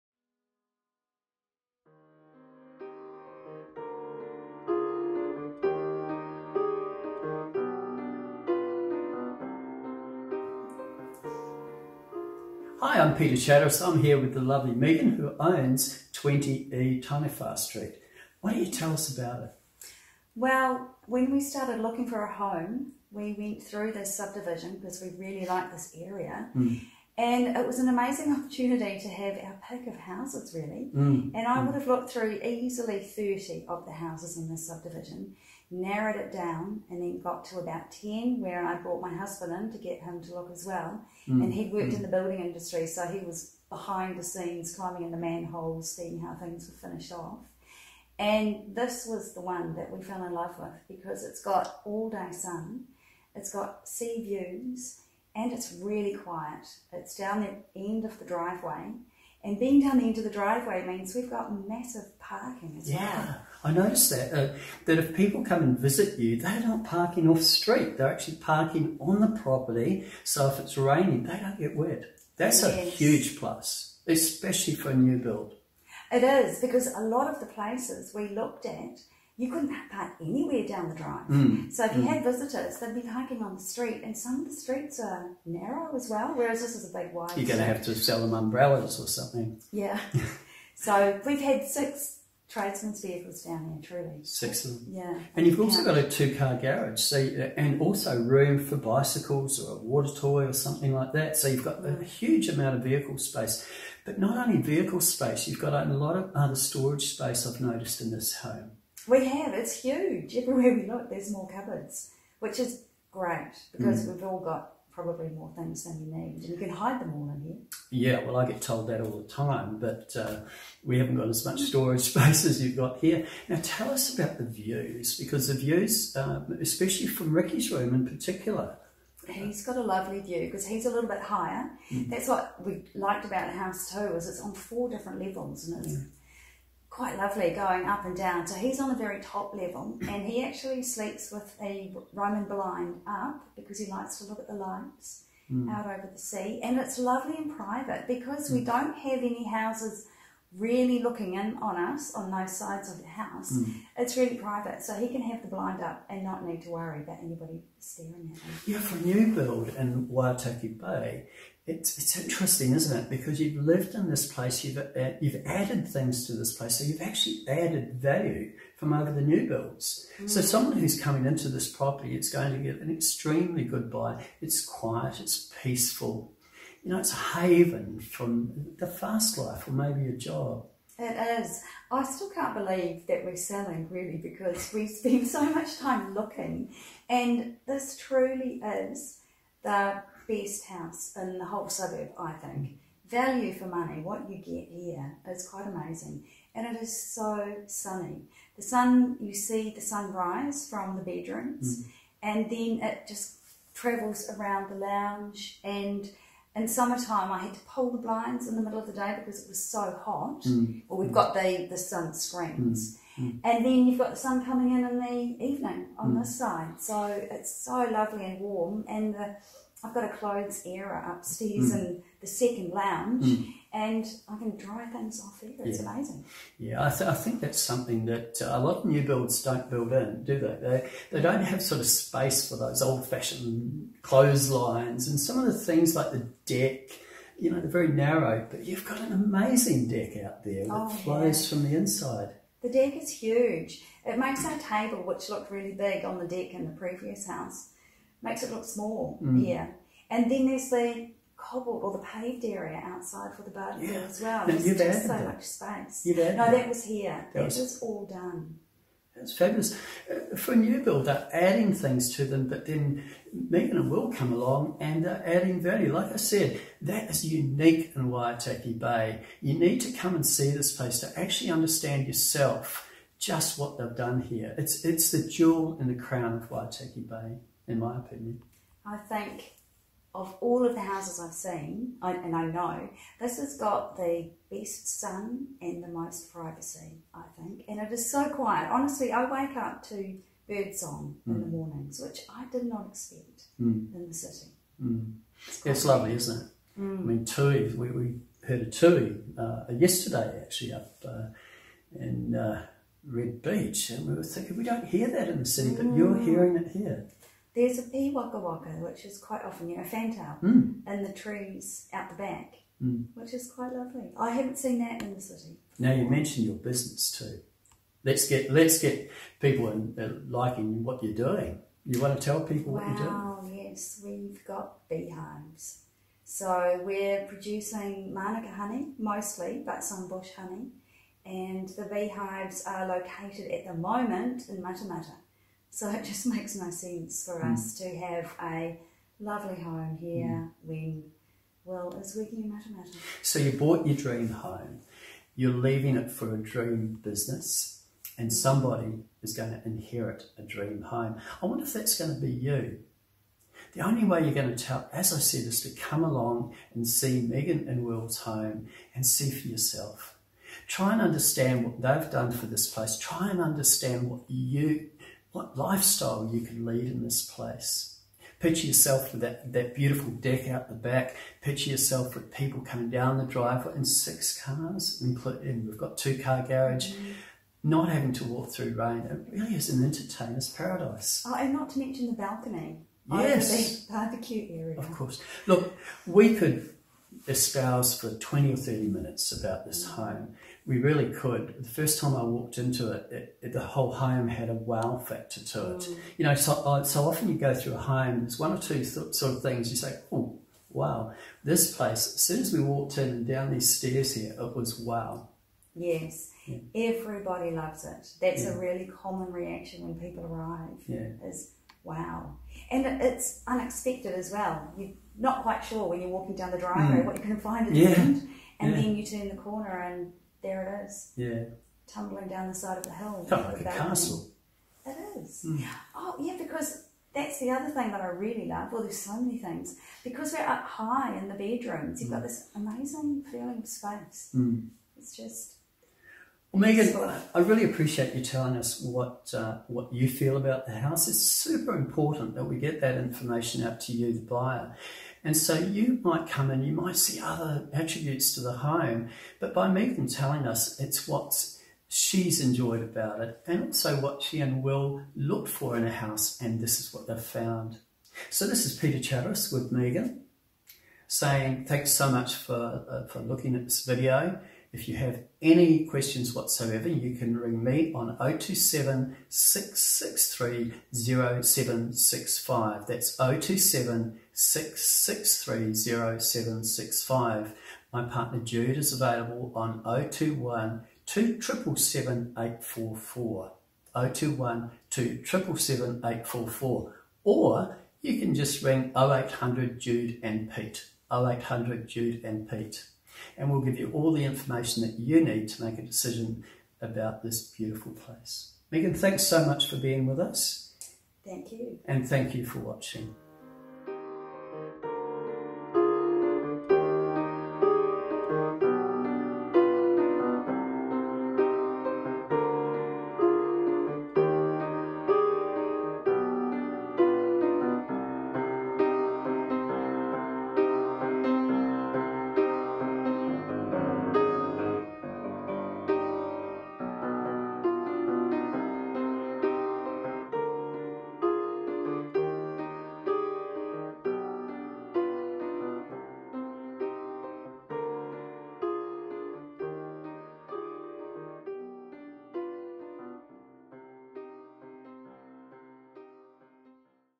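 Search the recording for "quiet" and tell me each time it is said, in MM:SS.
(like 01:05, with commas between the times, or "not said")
00:56, 02:54, 04:48.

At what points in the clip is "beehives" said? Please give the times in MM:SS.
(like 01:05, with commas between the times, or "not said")
05:24, 05:31.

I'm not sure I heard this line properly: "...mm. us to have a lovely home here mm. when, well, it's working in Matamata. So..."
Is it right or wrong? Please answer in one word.
right.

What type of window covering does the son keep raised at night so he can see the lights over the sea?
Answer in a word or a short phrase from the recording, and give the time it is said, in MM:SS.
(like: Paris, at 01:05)
Roman blind, at 02:22.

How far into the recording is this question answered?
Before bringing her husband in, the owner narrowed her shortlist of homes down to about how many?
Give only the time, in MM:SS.
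00:37.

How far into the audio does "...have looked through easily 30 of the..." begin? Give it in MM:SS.
00:31.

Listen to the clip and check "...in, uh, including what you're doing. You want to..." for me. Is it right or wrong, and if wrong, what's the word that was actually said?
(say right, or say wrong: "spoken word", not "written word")
wrong: "liking", not "including".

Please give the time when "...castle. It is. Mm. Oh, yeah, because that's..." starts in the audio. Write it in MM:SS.
07:03.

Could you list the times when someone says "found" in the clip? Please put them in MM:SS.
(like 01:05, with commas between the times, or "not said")
07:37.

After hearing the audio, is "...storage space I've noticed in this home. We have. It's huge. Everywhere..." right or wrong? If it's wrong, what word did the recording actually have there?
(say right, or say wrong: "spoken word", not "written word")
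right.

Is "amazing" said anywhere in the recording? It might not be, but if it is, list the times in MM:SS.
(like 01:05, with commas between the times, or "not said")
00:27, 03:15, 03:45, 03:59, 07:12.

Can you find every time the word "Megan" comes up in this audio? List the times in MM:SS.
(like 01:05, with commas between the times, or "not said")
00:14, 04:23, 05:57, 07:16, 07:29, 07:39, 08:18.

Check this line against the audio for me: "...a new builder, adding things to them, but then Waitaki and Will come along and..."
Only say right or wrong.
wrong.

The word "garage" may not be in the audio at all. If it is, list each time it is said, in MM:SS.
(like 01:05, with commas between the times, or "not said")
01:36, 06:16.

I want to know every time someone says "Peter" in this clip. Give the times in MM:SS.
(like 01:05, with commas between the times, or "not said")
00:13, 07:38.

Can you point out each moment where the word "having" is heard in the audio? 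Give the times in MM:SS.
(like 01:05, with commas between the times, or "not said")
06:17.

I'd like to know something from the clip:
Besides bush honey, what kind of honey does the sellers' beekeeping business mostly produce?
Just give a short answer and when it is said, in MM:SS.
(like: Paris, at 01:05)
Manuka honey, at 05:28.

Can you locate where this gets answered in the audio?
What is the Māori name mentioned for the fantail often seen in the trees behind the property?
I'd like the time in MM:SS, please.
05:07.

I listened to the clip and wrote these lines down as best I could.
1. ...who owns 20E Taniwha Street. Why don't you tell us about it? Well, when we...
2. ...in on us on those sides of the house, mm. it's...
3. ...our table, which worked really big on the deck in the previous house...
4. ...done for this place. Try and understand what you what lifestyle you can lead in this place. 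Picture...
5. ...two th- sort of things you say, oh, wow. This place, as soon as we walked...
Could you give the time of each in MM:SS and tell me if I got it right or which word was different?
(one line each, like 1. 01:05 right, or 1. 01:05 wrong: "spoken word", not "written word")
1. 00:15 right
2. 02:31 right
3. 04:04 wrong: "looked", not "worked"
4. 06:02 right
5. 06:38 right.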